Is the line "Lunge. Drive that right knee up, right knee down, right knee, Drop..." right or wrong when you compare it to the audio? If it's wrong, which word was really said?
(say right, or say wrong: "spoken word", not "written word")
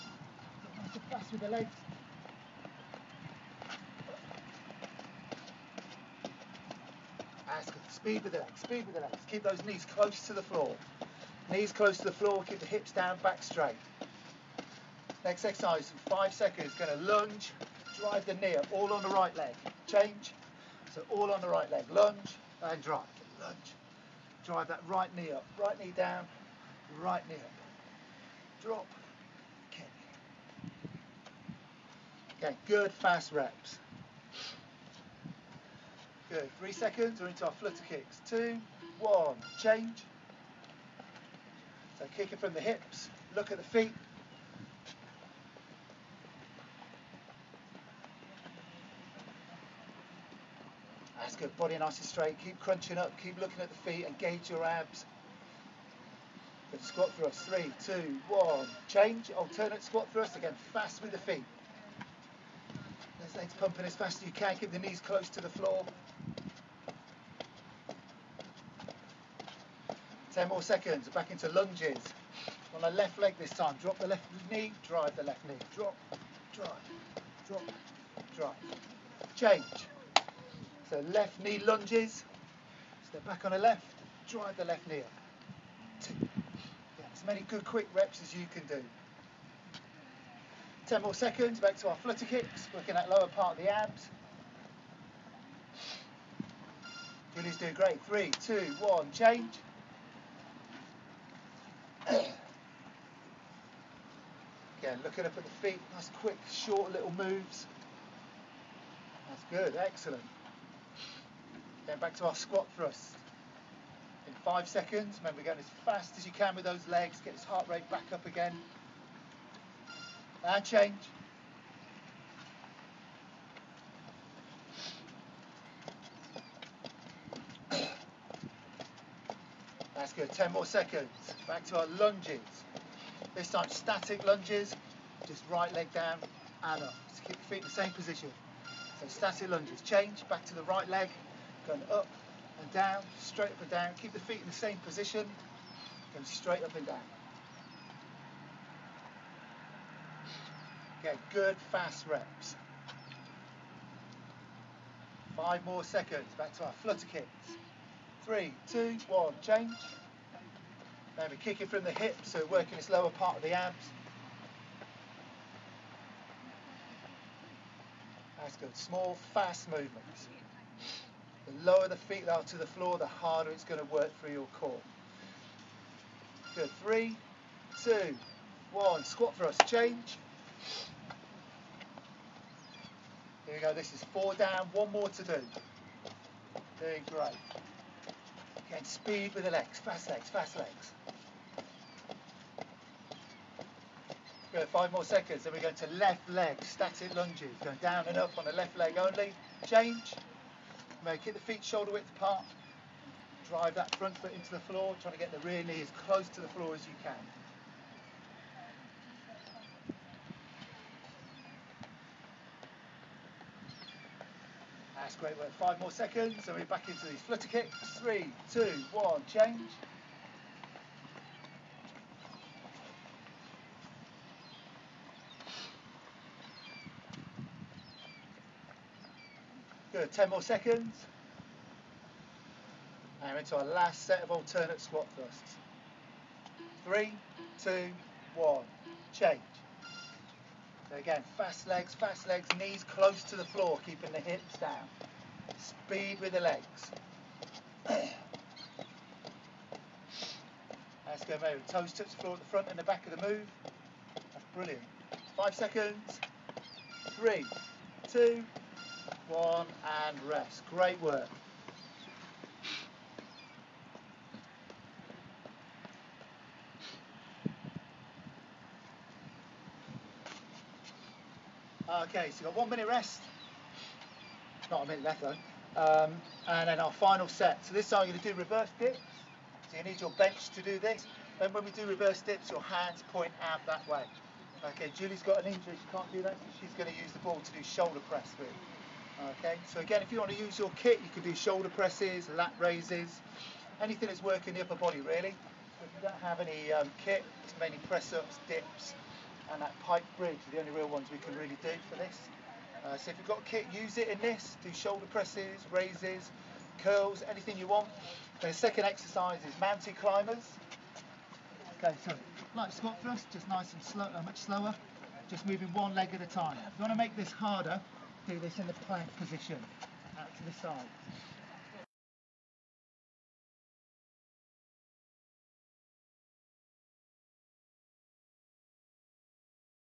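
right.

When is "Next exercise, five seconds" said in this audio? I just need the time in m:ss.
0:15.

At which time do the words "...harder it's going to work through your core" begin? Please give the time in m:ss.
2:53.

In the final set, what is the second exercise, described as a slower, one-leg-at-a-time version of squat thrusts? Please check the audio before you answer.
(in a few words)
Mountain climbers.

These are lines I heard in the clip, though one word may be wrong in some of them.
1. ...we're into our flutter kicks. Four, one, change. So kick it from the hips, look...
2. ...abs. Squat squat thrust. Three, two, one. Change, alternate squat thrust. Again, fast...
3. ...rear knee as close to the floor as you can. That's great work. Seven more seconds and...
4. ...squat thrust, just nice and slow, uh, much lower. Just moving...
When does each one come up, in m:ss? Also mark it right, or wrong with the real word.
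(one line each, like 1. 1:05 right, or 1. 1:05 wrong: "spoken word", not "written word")
1. 0:37 wrong: "Two", not "Four"
2. 0:54 right
3. 3:25 wrong: "Five", not "Seven"
4. 5:12 wrong: "slower", not "lower".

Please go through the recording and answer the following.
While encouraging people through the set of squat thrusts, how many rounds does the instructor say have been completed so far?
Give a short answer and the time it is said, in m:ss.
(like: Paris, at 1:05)
4, at 3:04.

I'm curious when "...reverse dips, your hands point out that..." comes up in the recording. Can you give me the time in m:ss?
4:41.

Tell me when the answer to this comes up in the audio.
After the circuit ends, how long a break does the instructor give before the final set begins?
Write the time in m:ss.
4:32.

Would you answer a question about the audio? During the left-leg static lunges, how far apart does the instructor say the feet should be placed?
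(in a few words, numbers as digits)
Shoulder width.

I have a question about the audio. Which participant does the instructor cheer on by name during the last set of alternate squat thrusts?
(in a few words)
Mary.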